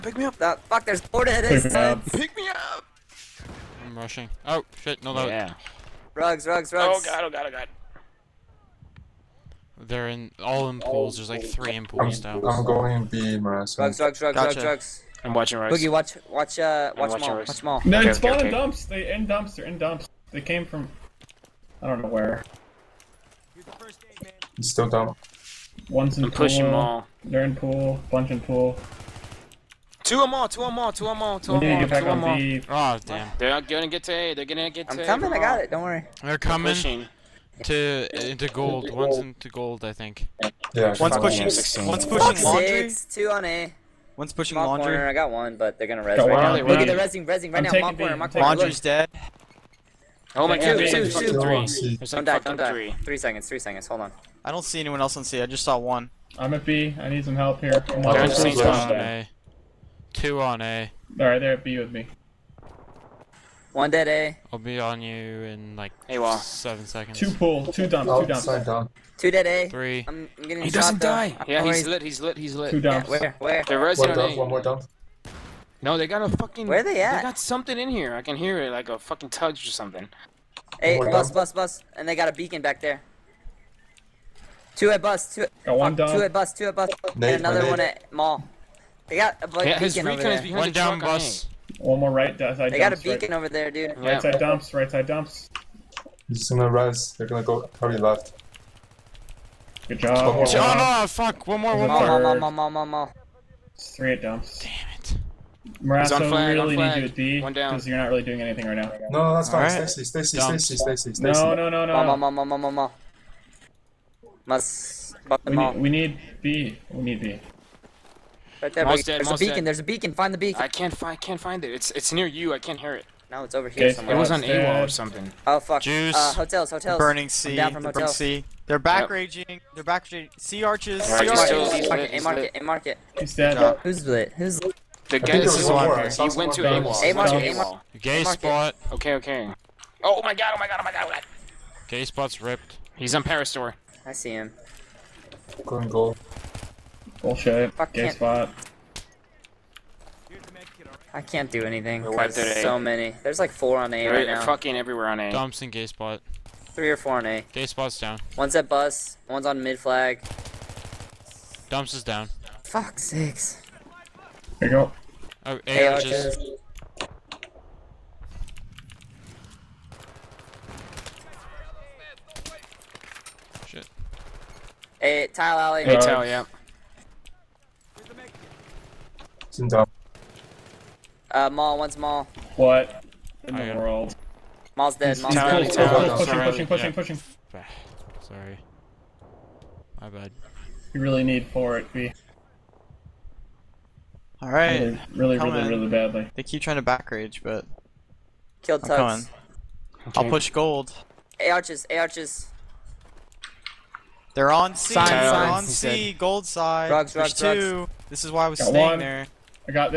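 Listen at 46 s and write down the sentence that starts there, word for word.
Look at the resing, resing right I'm now.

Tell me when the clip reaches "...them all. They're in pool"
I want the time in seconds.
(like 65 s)
26 s.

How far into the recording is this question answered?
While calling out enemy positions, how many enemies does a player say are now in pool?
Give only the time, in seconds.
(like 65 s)
11 s.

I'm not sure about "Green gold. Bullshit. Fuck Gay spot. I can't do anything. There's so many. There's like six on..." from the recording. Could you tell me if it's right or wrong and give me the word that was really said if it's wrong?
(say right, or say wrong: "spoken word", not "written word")
wrong: "four", not "six".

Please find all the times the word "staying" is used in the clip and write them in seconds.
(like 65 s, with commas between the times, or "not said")
208 s.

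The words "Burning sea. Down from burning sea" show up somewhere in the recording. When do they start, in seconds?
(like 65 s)
126 s.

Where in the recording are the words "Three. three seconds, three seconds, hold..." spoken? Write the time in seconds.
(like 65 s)
52 s.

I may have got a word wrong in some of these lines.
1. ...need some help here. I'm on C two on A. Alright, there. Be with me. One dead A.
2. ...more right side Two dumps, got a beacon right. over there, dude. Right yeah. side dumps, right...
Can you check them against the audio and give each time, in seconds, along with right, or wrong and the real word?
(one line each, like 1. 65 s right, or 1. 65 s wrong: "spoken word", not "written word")
1. 57 s right
2. 92 s wrong: "They", not "Two".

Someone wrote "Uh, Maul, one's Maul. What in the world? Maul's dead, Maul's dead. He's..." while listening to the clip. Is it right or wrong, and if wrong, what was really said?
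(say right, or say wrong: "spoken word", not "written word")
right.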